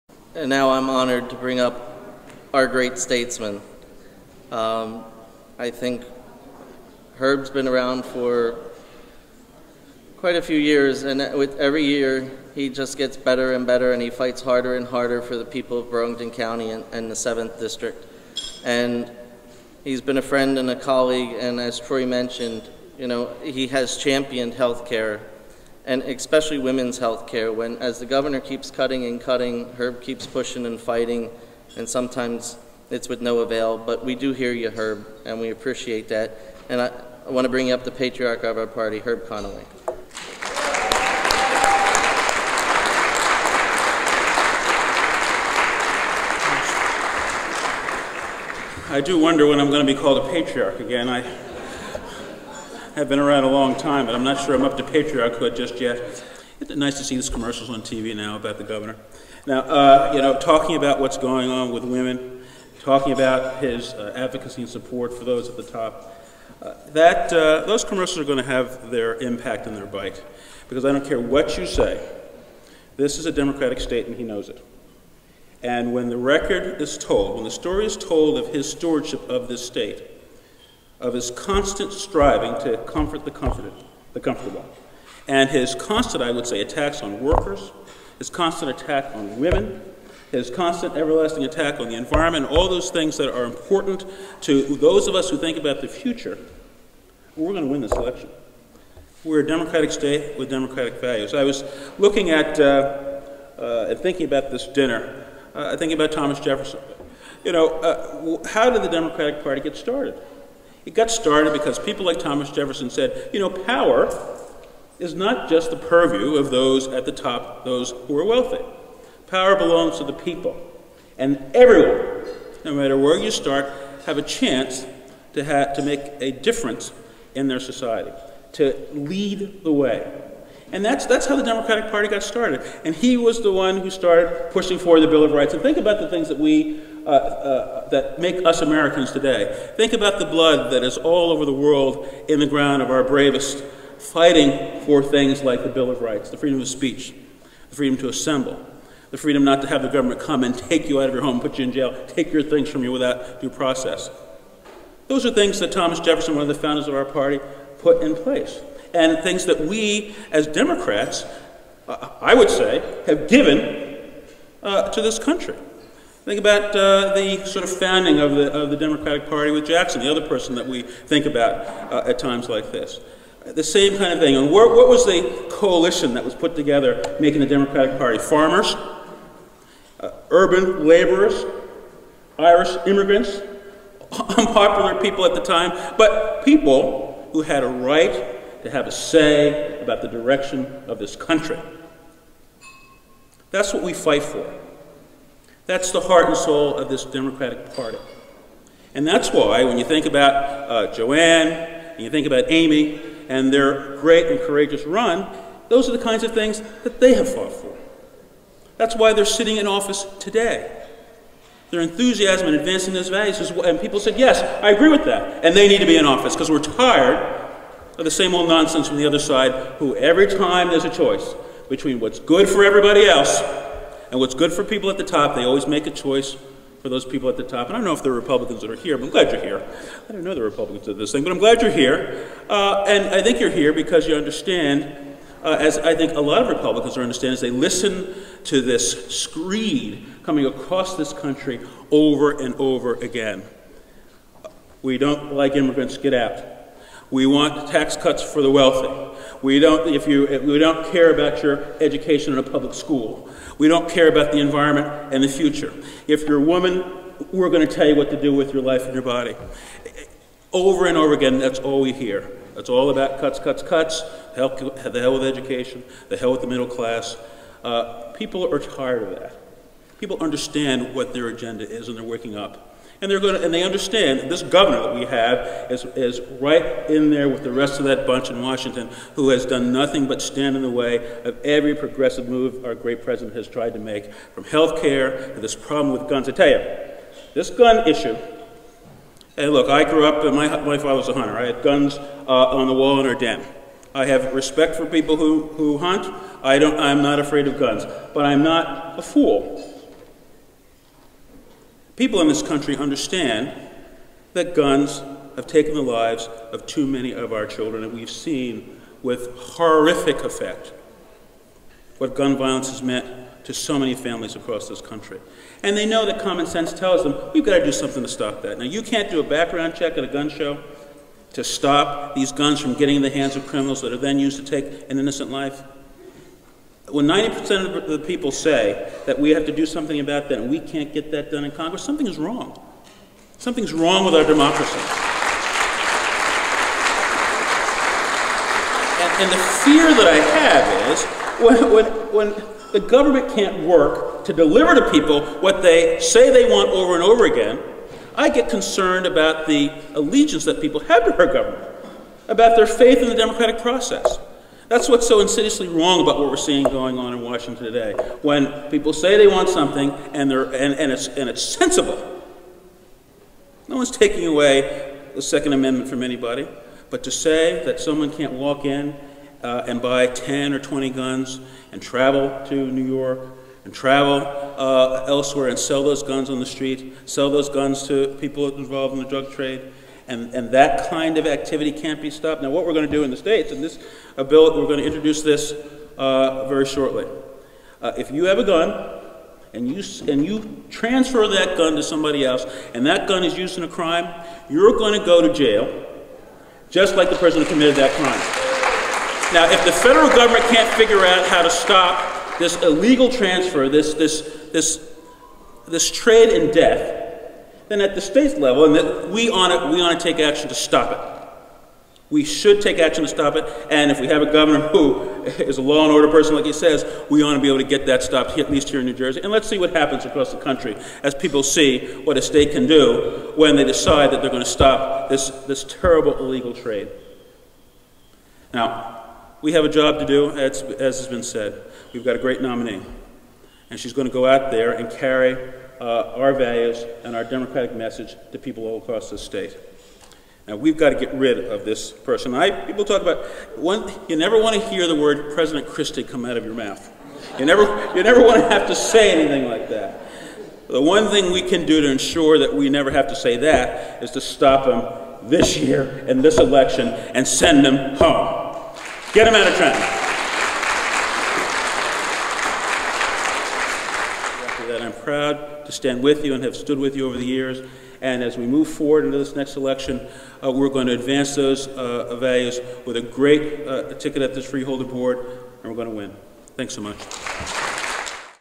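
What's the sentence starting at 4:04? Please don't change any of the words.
We don't like immigrants, get out.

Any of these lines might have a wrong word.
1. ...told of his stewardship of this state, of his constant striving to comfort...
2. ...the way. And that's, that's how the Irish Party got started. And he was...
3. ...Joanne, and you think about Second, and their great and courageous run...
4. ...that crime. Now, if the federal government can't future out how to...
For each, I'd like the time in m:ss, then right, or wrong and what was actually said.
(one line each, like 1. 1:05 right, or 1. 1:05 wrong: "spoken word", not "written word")
1. 1:17 right
2. 2:09 wrong: "Democratic", not "Irish"
3. 3:20 wrong: "Amy", not "Second"
4. 6:37 wrong: "figure", not "future".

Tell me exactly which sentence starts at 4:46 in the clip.
I tell you, this gun issue and look, I grew up, my, my father was a hunter.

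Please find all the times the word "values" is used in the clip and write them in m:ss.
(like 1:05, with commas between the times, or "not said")
1:41, 3:33, 7:16, 7:52.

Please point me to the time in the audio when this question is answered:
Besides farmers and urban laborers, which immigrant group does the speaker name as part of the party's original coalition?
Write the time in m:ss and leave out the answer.
3:02.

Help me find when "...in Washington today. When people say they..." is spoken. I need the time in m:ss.
5:57.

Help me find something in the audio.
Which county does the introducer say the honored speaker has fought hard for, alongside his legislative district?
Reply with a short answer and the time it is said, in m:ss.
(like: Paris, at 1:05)
Burlington County, at 0:15.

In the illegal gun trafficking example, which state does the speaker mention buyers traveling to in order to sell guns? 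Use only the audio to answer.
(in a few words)
New York.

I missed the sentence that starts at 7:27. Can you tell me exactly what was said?
You never, you never want to have to say anything like that.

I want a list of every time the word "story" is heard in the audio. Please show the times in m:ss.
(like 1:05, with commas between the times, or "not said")
1:17.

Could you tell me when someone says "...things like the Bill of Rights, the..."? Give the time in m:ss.
2:25.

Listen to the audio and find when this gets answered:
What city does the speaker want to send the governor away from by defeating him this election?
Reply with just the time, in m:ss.
7:39.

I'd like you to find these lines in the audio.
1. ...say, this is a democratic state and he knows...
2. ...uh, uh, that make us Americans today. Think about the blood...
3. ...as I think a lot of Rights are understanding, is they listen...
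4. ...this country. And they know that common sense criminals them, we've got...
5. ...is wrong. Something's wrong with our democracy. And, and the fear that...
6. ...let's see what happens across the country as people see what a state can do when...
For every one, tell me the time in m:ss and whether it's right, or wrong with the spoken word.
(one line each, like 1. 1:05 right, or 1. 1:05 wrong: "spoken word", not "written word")
1. 1:11 right
2. 2:17 right
3. 3:55 wrong: "Republicans", not "Rights"
4. 5:14 wrong: "tells", not "criminals"
5. 5:32 right
6. 6:59 right.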